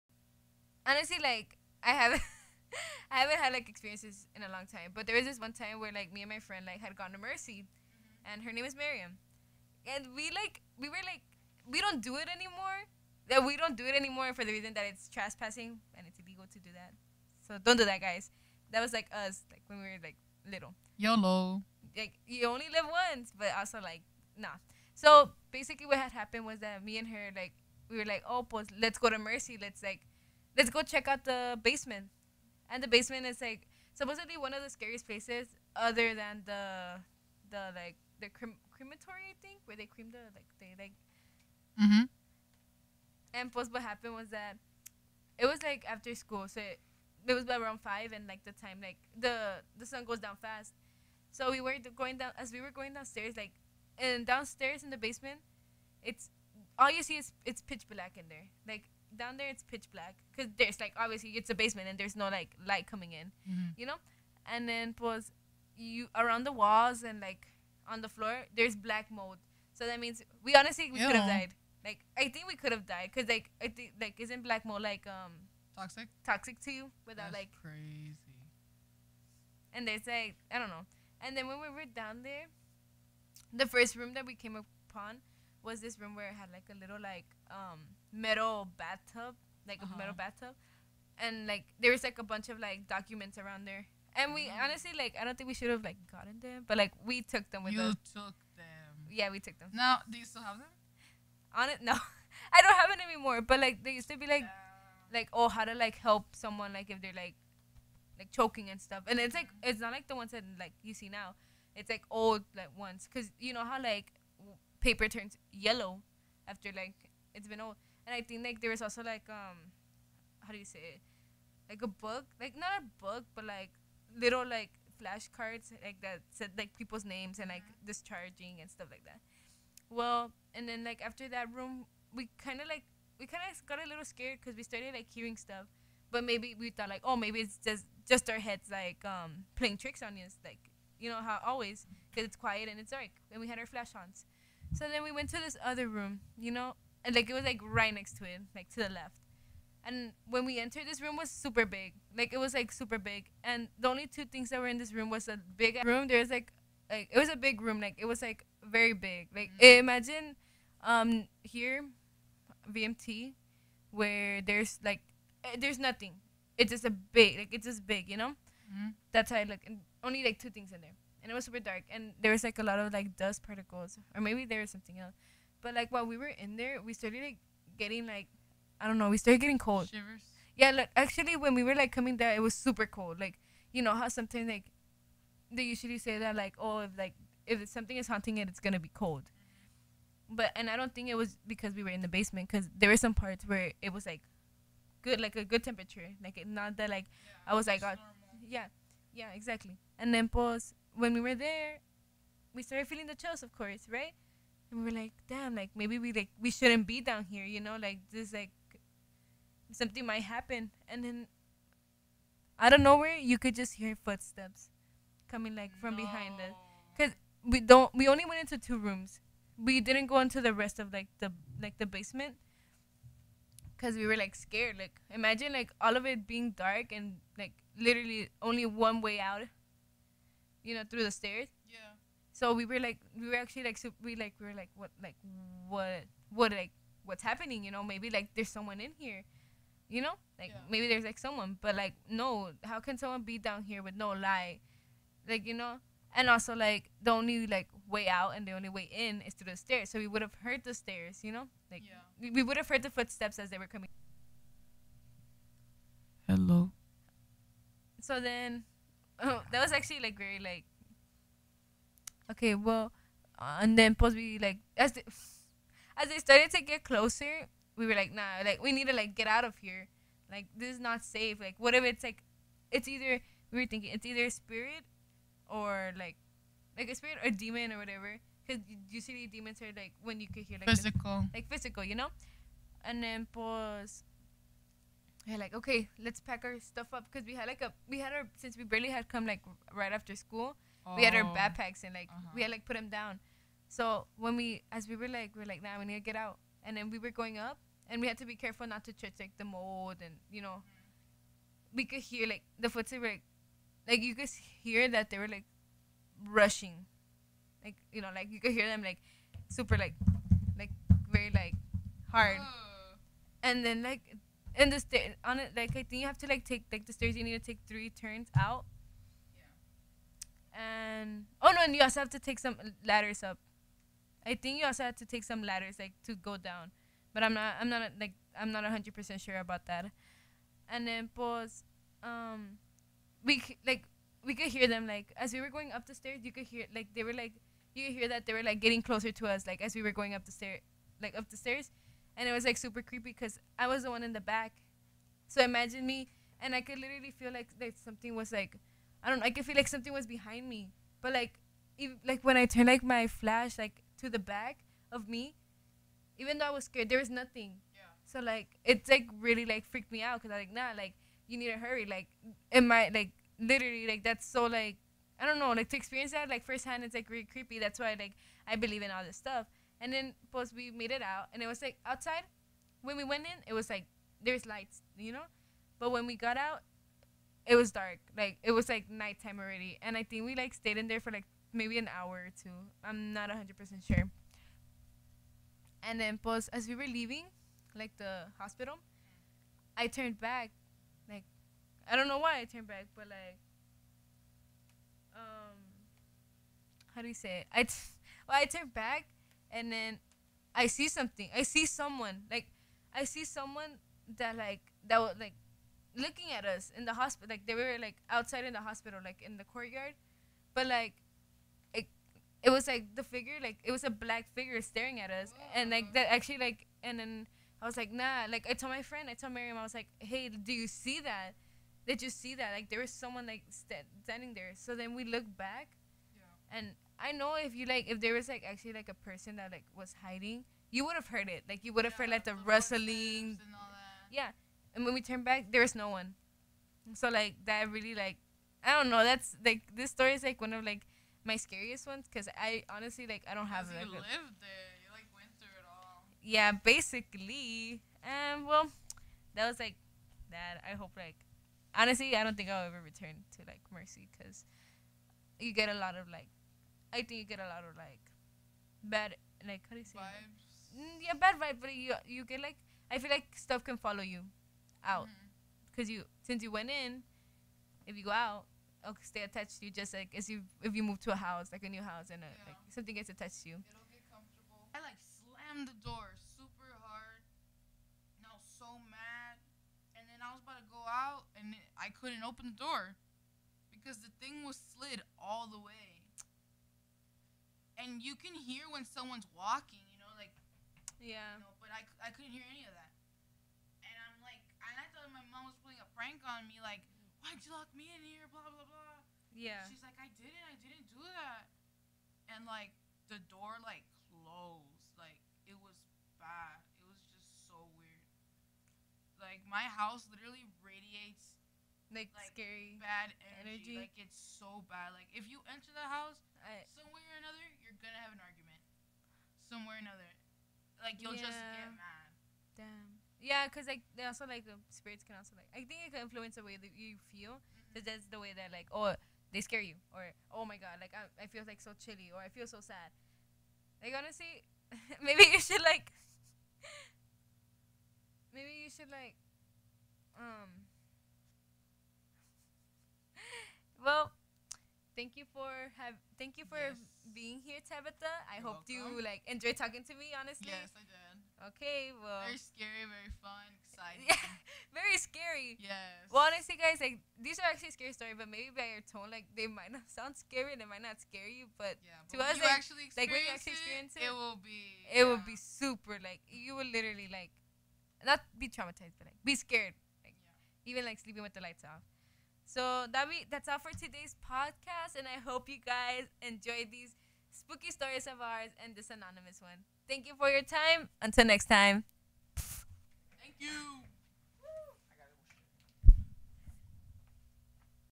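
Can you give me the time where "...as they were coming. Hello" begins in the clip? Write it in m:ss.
4:13.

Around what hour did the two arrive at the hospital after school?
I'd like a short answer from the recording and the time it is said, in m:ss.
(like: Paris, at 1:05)
5, at 0:47.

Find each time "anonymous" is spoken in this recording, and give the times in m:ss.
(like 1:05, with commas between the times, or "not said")
9:38.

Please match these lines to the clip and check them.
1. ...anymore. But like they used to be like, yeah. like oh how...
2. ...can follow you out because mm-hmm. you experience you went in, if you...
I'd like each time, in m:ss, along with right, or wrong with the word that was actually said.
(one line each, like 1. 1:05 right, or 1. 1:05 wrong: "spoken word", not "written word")
1. 1:43 right
2. 7:43 wrong: "since", not "experience".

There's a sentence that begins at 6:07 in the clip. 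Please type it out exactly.
That's why like I believe in all this stuff.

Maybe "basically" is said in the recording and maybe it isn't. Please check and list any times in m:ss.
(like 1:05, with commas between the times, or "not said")
0:25, 7:26.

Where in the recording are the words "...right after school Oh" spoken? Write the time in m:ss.
4:49.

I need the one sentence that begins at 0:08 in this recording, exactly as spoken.
and her name is Miriam, and we like we were like we don't do it anymore.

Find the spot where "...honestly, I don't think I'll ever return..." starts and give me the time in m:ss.
7:31.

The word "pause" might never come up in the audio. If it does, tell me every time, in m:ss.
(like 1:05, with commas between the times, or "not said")
3:20, 4:43, 5:31.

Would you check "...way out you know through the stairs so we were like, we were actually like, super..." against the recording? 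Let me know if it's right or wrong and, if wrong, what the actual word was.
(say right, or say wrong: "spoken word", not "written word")
right.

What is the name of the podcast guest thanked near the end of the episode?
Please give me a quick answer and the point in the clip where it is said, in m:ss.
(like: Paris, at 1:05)
Tabitha, at 9:07.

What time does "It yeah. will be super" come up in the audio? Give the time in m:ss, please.
9:24.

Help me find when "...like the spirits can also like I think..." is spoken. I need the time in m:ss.
8:44.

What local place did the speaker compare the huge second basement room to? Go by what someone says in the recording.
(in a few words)
VMT.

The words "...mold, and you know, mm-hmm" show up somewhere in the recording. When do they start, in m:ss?
4:59.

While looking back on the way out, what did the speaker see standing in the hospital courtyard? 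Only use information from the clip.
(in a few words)
black figure.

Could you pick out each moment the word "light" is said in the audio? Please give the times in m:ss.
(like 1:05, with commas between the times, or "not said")
1:02, 4:04, 6:14, 9:31.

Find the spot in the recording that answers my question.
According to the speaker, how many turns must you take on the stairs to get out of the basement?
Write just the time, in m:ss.
5:17.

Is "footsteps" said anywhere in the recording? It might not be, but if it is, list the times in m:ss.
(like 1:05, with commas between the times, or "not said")
3:34, 4:12, 5:02.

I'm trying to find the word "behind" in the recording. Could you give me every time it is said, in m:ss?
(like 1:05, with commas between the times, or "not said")
3:36, 5:50.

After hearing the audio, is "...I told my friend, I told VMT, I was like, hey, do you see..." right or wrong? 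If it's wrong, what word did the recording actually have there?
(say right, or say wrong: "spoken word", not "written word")
wrong: "Miriam", not "VMT".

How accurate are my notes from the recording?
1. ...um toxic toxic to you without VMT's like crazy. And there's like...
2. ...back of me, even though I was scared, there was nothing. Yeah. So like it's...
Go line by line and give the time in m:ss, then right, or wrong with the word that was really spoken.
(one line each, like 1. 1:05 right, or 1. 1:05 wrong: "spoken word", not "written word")
1. 1:15 wrong: "That", not "VMT"
2. 5:54 right.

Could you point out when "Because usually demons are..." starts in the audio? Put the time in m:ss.
4:38.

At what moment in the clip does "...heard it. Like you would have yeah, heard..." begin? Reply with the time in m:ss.
7:11.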